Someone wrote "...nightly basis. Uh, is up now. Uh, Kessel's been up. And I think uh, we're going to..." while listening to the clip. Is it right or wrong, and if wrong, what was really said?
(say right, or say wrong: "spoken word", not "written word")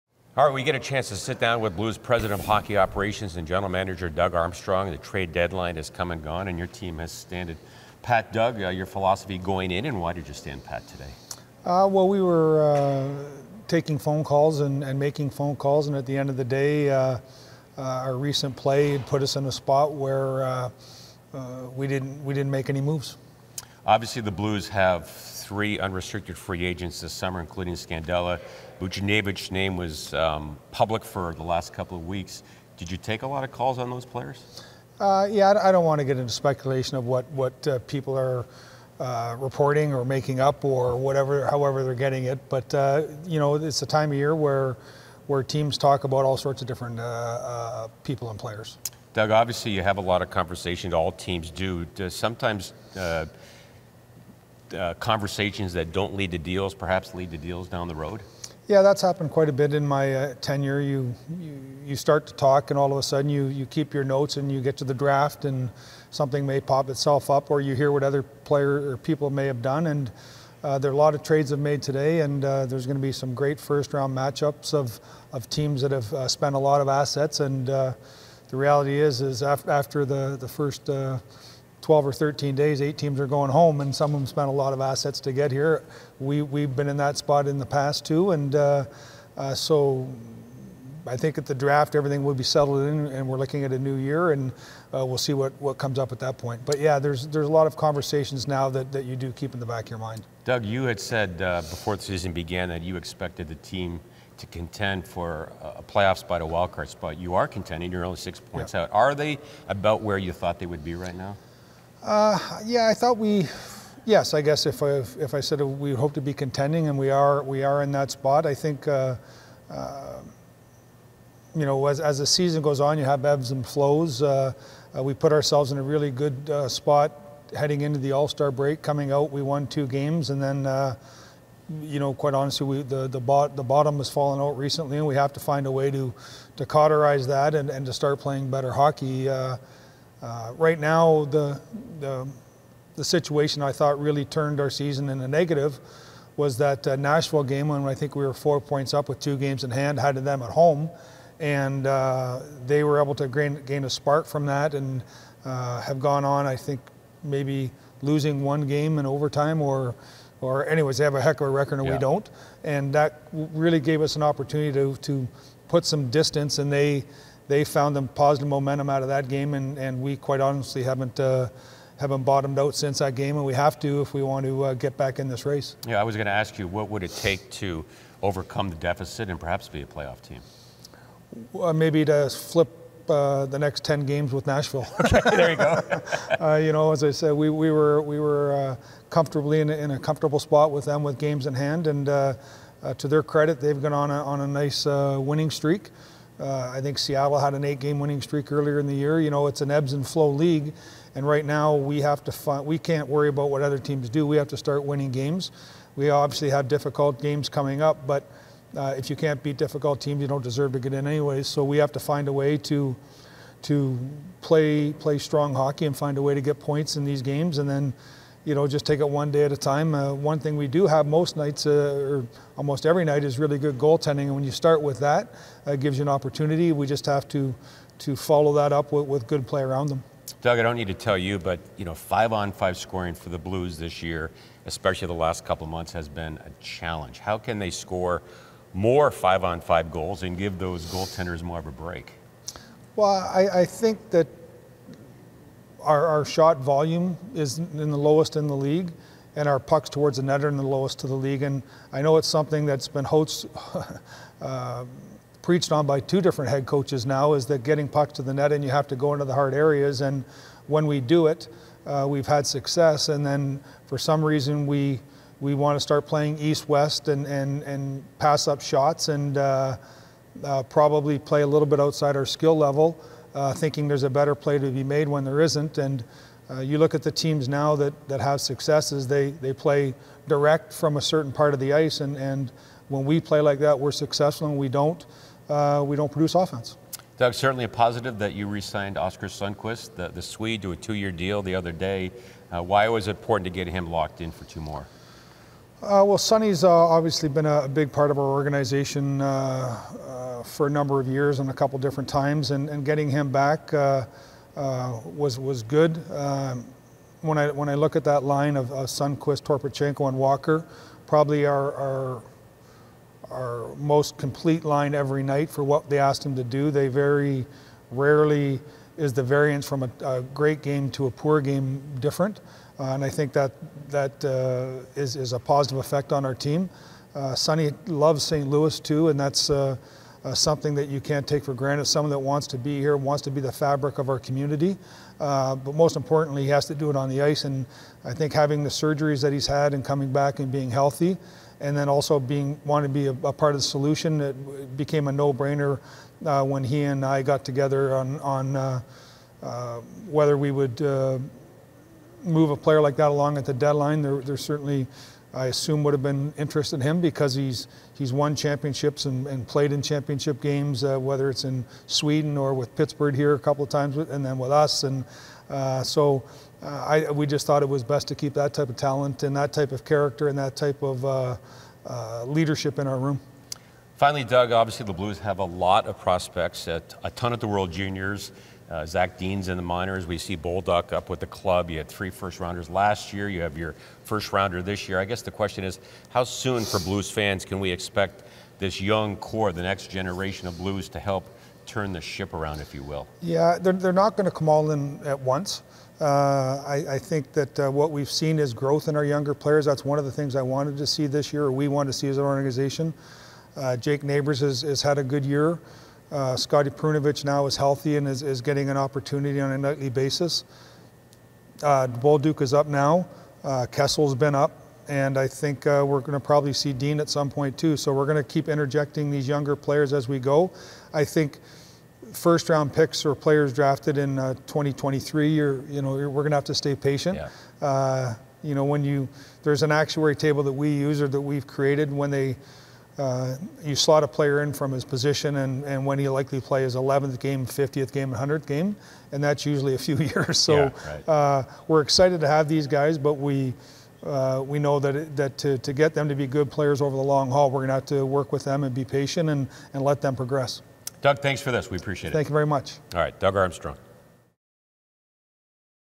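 right.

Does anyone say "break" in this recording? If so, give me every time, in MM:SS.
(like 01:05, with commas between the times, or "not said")
02:08, 04:01.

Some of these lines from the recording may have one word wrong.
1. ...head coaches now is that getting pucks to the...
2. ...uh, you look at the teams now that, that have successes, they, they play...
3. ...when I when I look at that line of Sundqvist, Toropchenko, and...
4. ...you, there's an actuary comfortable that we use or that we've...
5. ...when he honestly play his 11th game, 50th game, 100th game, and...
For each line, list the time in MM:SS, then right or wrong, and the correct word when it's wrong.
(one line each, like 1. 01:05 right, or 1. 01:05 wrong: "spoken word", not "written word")
1. 04:16 right
2. 04:36 right
3. 05:07 right
4. 07:08 wrong: "table", not "comfortable"
5. 07:15 wrong: "likely", not "honestly".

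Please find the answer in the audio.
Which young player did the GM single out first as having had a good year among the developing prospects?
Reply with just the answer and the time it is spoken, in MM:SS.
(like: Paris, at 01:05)
Jake Neighbours, at 06:43.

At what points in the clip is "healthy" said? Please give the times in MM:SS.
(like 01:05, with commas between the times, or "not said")
05:40, 06:47.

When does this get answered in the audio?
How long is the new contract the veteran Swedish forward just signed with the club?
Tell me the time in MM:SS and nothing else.
04:50.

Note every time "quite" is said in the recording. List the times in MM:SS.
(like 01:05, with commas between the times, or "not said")
00:59, 02:12, 02:50.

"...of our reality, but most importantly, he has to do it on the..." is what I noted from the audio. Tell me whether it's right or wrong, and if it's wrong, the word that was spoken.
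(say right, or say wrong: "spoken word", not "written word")
wrong: "community", not "reality".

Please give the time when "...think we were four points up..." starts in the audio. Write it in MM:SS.
02:27.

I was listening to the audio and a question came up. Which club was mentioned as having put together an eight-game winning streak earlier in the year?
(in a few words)
Seattle.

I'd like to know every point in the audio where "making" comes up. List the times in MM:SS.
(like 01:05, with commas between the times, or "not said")
00:14, 00:40.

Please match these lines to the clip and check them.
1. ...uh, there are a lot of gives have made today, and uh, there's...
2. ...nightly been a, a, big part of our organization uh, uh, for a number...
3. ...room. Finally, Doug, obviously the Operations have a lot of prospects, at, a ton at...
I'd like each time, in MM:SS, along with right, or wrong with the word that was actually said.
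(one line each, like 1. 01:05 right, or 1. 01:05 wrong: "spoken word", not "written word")
1. 01:10 wrong: "trades", not "gives"
2. 04:56 wrong: "obviously", not "nightly"
3. 06:12 wrong: "Blues", not "Operations".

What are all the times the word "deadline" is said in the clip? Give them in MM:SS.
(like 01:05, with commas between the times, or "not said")
00:05, 05:53.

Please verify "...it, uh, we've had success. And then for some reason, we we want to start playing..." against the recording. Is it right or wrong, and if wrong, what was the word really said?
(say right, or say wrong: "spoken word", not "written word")
right.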